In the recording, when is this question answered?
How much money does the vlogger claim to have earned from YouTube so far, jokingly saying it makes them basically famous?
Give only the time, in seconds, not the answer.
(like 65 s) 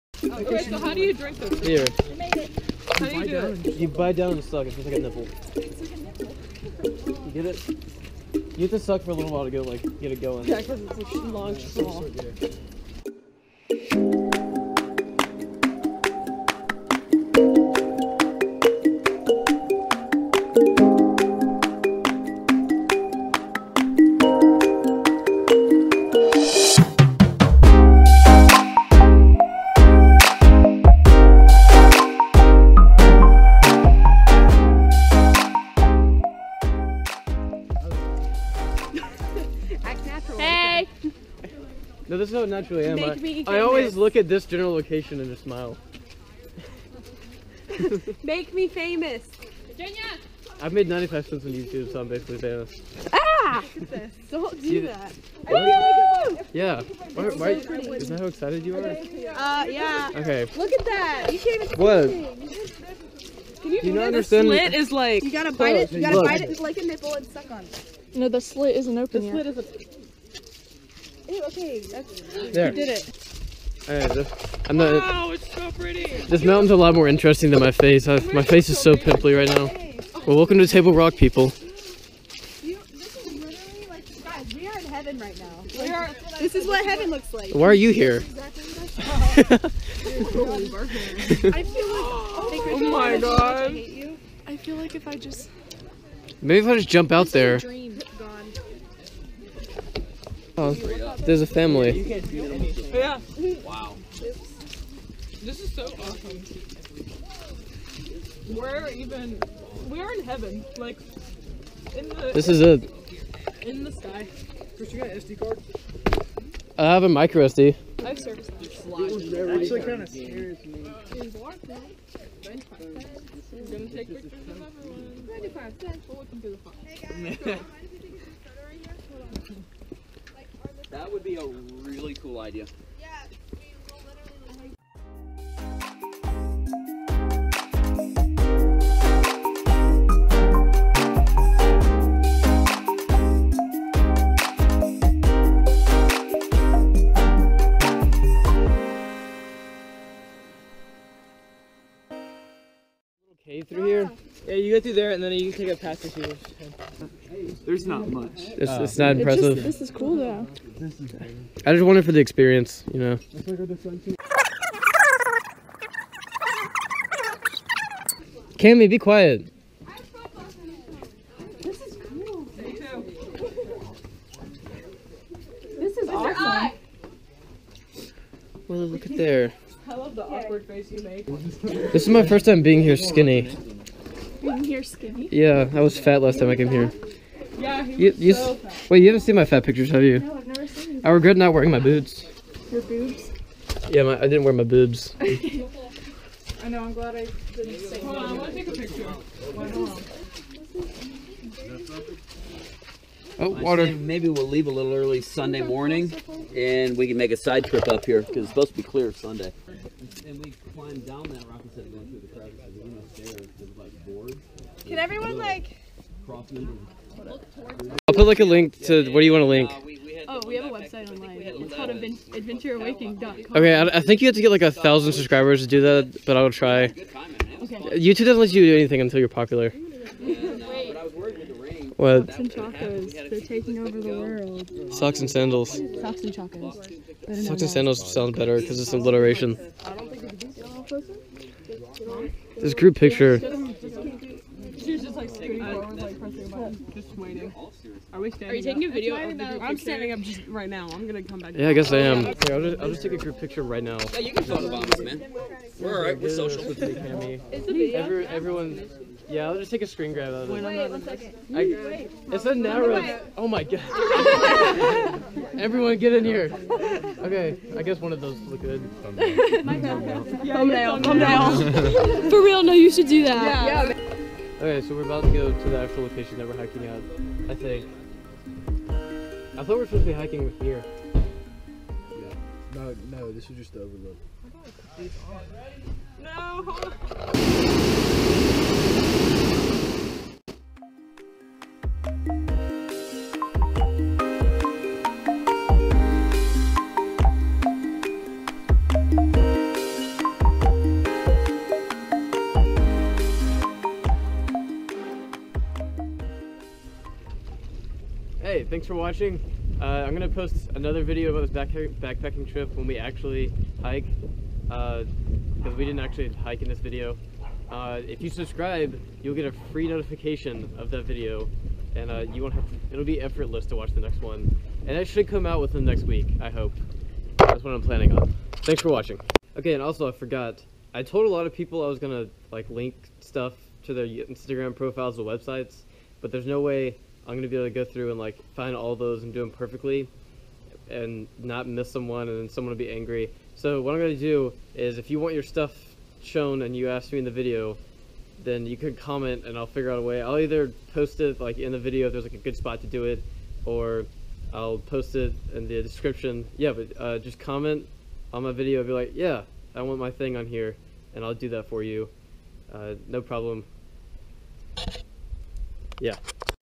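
50 s.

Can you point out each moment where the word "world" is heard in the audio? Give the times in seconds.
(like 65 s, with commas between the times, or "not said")
234 s.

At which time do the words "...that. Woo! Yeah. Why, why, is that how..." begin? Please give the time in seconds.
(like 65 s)
54 s.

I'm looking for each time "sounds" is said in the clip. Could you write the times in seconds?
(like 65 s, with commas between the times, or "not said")
238 s.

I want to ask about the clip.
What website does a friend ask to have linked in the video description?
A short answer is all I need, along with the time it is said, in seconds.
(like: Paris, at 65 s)
adventureawaking.com, at 222 s.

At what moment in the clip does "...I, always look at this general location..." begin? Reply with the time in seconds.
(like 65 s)
43 s.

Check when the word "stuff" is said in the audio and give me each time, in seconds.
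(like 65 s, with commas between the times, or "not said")
333 s, 345 s.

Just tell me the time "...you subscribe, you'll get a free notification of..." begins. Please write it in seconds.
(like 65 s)
318 s.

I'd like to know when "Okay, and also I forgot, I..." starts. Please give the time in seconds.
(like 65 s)
329 s.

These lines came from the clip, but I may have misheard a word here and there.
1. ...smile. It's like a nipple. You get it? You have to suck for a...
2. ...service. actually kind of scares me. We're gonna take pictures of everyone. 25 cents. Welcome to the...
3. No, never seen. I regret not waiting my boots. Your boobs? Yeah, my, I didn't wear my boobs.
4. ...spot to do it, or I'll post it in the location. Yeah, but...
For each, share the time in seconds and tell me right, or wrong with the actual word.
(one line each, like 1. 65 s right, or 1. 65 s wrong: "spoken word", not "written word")
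1. 5 s wrong: "nipple", not "smile"
2. 118 s right
3. 190 s wrong: "wearing", not "waiting"
4. 352 s wrong: "description", not "location".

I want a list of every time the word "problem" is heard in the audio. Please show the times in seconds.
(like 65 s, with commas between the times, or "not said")
363 s.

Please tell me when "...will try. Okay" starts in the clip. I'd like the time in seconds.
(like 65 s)
226 s.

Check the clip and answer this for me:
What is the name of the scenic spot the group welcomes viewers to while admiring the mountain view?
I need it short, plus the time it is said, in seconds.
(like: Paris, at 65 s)
Table Rock, at 80 s.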